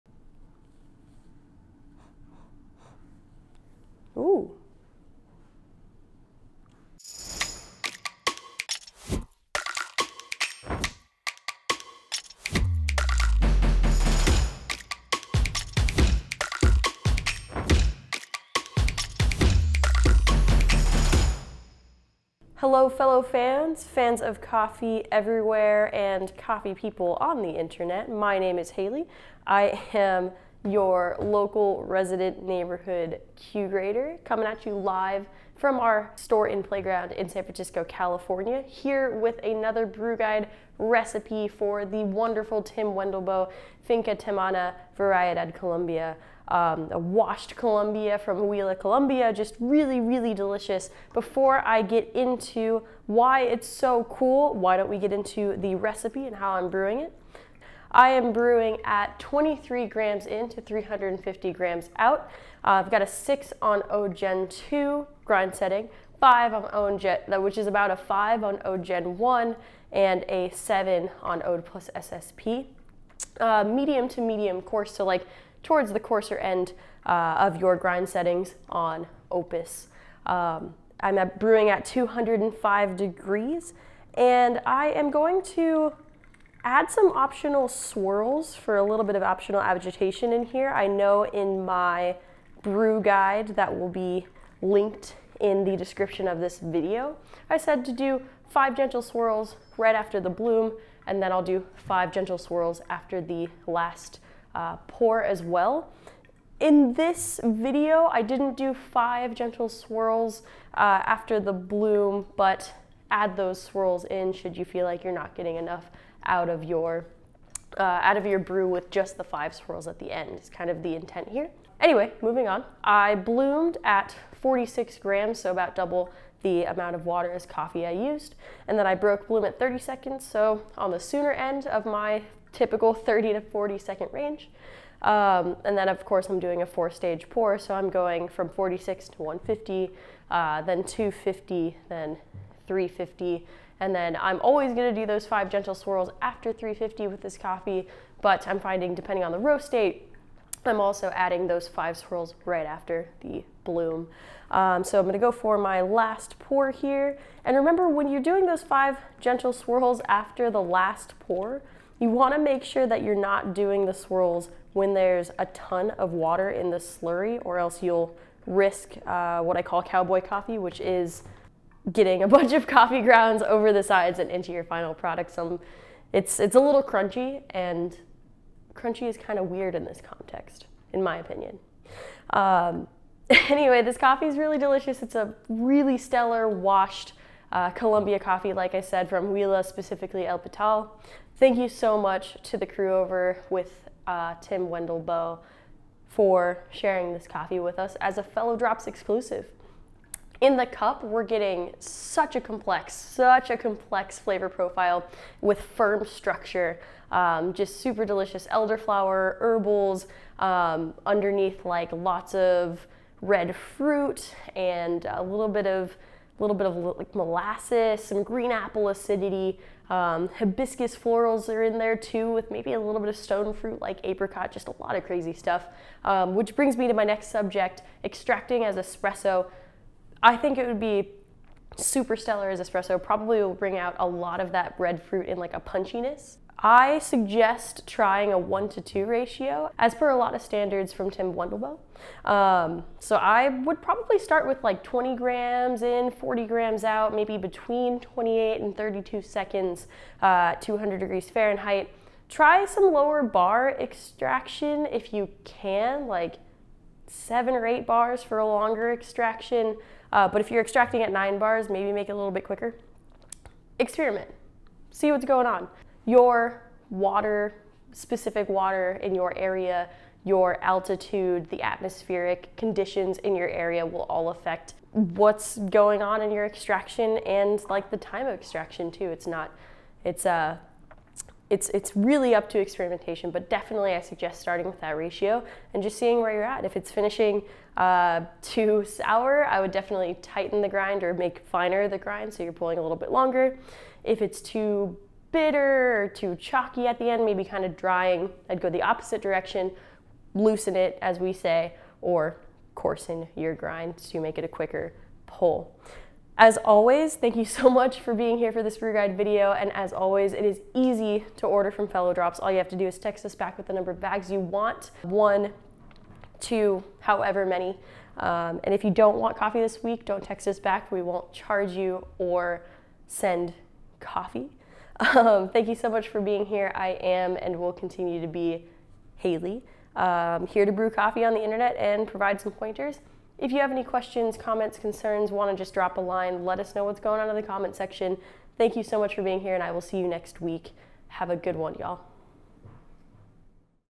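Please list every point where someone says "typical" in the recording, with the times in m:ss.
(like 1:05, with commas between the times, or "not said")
2:12.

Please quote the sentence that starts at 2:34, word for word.
Um, so I'm gonna go for my last pour here.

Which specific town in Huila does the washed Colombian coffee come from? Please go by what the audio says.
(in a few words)
El Pital.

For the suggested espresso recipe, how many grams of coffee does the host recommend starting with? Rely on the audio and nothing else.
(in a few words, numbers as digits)
20 grams.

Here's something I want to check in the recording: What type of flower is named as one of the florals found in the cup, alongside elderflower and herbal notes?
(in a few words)
hibiscus.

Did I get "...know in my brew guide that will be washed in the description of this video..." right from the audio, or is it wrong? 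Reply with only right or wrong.
wrong.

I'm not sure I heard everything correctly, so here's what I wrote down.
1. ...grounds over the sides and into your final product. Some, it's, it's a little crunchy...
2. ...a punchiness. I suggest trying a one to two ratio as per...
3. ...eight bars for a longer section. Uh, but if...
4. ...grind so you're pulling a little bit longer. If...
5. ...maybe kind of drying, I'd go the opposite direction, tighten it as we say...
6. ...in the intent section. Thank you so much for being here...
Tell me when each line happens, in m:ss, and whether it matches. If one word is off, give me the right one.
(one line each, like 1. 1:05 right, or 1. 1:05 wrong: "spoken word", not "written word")
1. 2:53 right
2. 3:55 right
3. 4:17 wrong: "extraction", not "section"
4. 4:51 right
5. 4:57 wrong: "loosen", not "tighten"
6. 5:37 wrong: "comment", not "intent".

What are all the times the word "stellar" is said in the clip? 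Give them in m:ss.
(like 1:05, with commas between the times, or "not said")
3:05, 3:52.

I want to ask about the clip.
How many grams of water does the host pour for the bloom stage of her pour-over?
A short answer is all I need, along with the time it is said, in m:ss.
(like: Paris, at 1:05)
46 grams, at 2:04.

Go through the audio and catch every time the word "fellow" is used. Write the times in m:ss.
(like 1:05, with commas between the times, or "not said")
0:22, 3:18, 5:11.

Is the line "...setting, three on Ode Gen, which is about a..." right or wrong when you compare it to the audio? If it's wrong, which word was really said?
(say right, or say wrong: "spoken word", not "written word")
wrong: "five", not "three".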